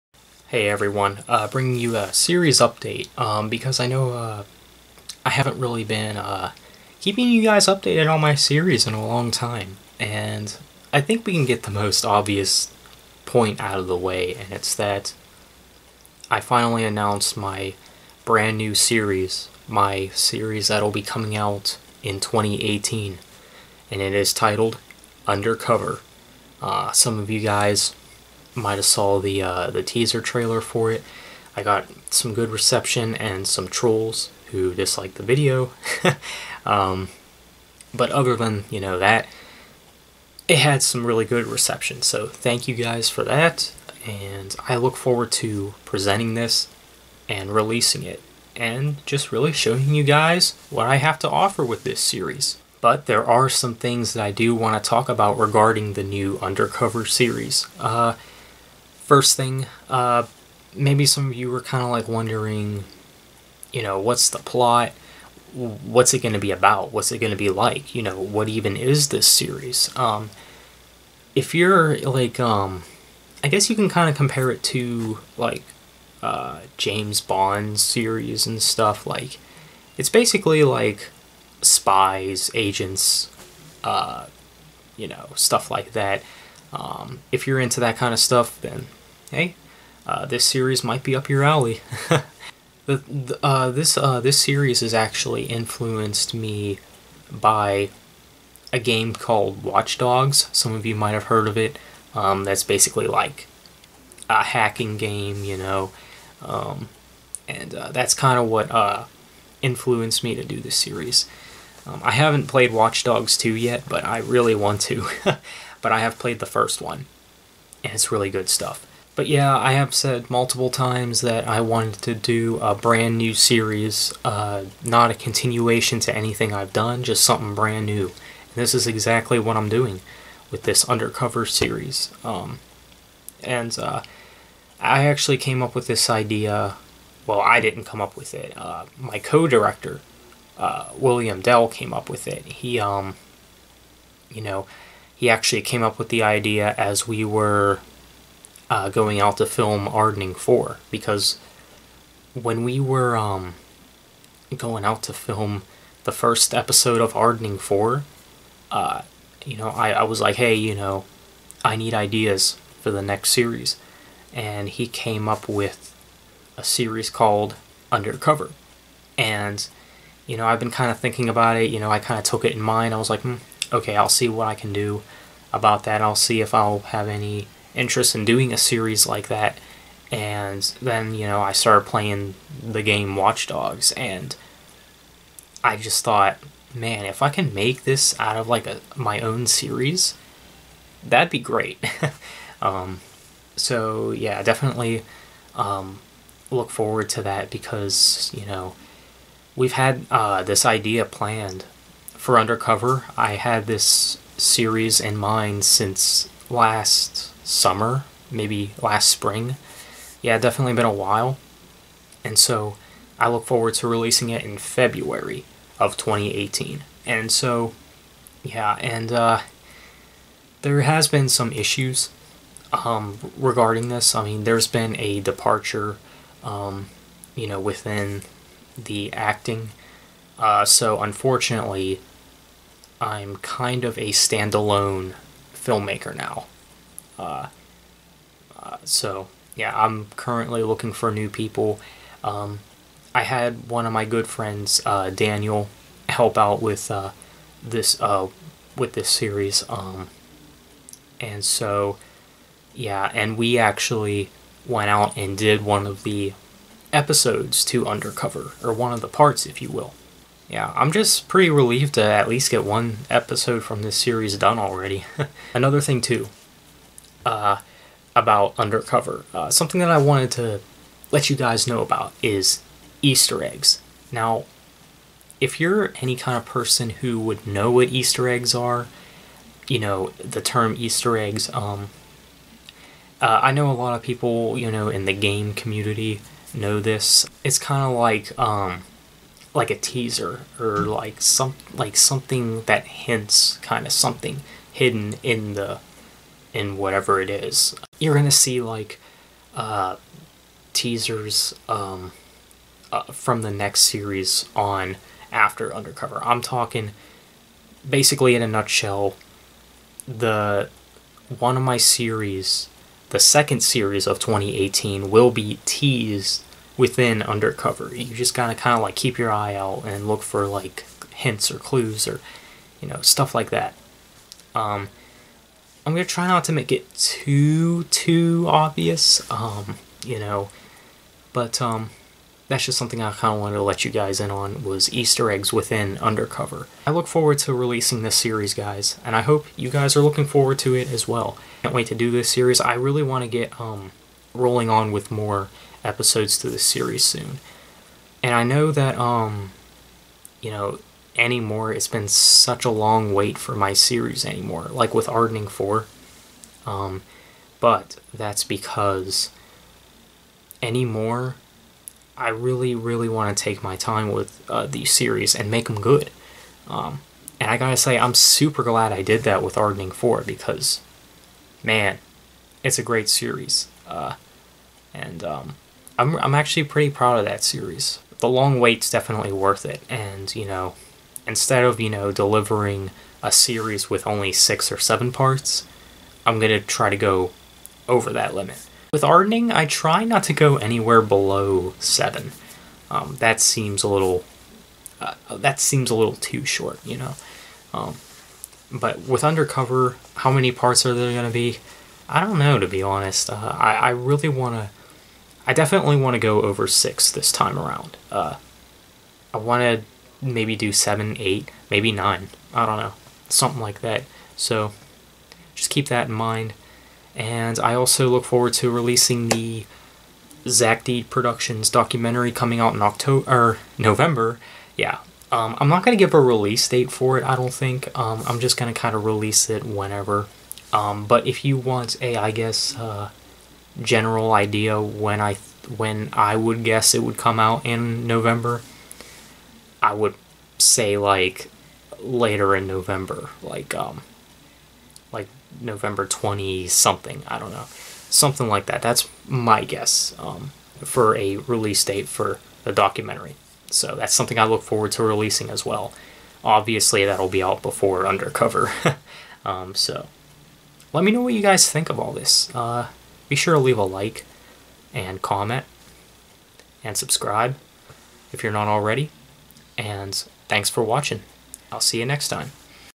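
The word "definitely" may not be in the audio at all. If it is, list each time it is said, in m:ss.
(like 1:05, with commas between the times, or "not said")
3:14, 3:30, 6:18, 6:45.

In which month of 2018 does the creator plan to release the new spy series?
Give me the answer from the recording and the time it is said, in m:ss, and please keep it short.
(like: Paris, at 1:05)
February, at 3:34.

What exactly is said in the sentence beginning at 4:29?
Uh, something that I wanted to let you guys know about is Easter eggs.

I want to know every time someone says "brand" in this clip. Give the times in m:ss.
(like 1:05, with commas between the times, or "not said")
0:18, 2:02, 2:07.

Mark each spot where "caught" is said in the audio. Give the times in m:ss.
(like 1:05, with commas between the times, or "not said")
not said.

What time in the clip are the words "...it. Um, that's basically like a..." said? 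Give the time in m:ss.
1:41.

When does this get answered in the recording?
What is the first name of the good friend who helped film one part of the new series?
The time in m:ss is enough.
4:05.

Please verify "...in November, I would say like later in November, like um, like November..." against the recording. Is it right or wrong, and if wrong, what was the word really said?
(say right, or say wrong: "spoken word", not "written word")
right.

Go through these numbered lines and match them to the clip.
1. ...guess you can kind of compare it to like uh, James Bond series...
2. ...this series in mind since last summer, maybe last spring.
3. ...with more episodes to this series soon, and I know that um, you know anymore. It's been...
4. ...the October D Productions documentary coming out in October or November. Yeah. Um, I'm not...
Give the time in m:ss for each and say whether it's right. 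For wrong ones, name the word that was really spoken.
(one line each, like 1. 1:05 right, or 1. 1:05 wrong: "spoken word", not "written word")
1. 1:13 right
2. 3:23 right
3. 5:44 right
4. 6:59 wrong: "Zach", not "October".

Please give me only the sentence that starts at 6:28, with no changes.
With Ardening, I try not to go anywhere below seven.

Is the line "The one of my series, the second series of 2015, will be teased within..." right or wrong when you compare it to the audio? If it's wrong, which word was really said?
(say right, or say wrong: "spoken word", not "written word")
wrong: "2018", not "2015".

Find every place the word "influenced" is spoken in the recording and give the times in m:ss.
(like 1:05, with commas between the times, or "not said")
1:35, 1:49.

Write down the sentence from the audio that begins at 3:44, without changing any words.
I mean, there's been a departure, um, you know, within the acting.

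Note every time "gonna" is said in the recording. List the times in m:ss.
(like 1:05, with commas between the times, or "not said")
4:58, 5:25.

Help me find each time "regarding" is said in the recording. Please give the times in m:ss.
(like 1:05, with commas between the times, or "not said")
0:55, 3:43.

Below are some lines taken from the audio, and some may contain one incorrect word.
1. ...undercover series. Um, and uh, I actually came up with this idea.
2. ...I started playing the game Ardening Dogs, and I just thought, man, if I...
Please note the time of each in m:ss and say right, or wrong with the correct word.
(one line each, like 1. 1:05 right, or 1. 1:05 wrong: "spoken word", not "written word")
1. 2:10 right
2. 3:01 wrong: "Watch", not "Ardening".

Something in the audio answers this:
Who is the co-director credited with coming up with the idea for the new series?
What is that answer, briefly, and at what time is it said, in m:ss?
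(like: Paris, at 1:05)
William Dell, at 2:20.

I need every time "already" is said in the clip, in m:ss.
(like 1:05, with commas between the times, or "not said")
4:24, 7:48.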